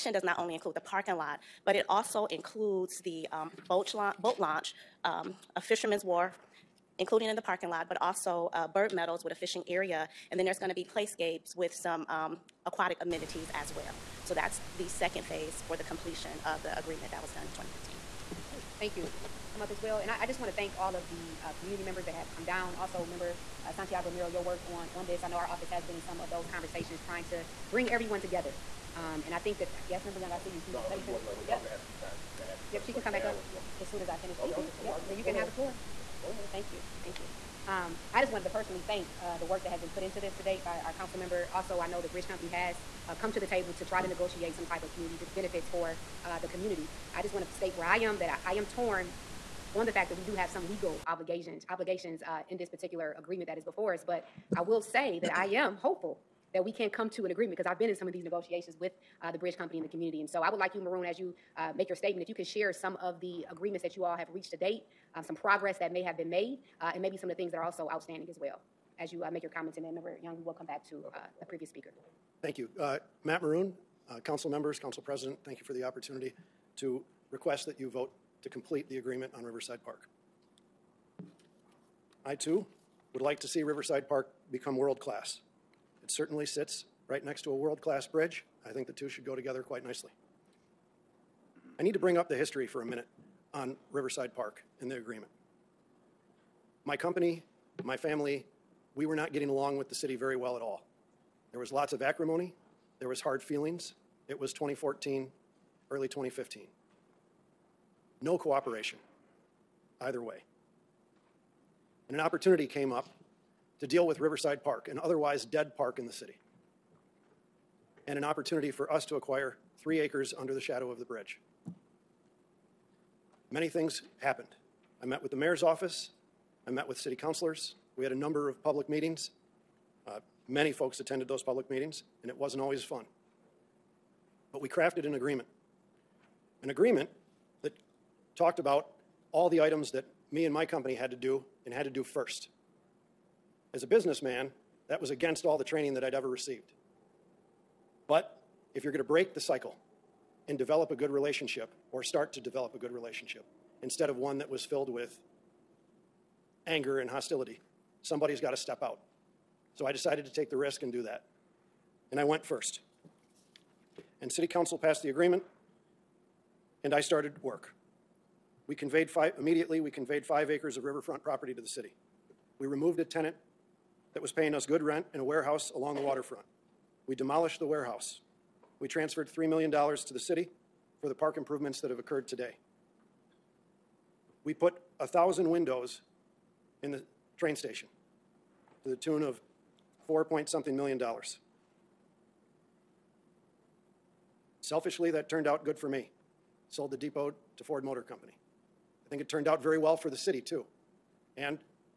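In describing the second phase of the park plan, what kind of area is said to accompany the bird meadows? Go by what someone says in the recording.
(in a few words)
fishing area.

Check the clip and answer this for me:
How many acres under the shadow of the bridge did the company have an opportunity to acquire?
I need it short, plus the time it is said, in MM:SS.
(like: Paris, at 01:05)
3, at 01:59.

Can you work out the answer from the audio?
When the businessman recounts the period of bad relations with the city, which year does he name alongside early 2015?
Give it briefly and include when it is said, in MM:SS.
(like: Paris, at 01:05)
2014, at 01:44.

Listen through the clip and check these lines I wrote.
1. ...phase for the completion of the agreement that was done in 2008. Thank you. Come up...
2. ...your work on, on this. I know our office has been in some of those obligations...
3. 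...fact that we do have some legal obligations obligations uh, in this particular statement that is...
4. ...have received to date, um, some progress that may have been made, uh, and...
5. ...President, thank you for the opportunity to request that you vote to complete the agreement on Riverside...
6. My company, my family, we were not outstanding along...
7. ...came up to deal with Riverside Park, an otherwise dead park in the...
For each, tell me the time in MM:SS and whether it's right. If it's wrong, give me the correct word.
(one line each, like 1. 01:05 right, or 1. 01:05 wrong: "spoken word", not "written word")
1. 00:15 wrong: "2015", not "2008"
2. 00:24 wrong: "conversations", not "obligations"
3. 00:49 wrong: "agreement", not "statement"
4. 01:04 wrong: "reached", not "received"
5. 01:14 right
6. 01:36 wrong: "getting", not "outstanding"
7. 01:52 right.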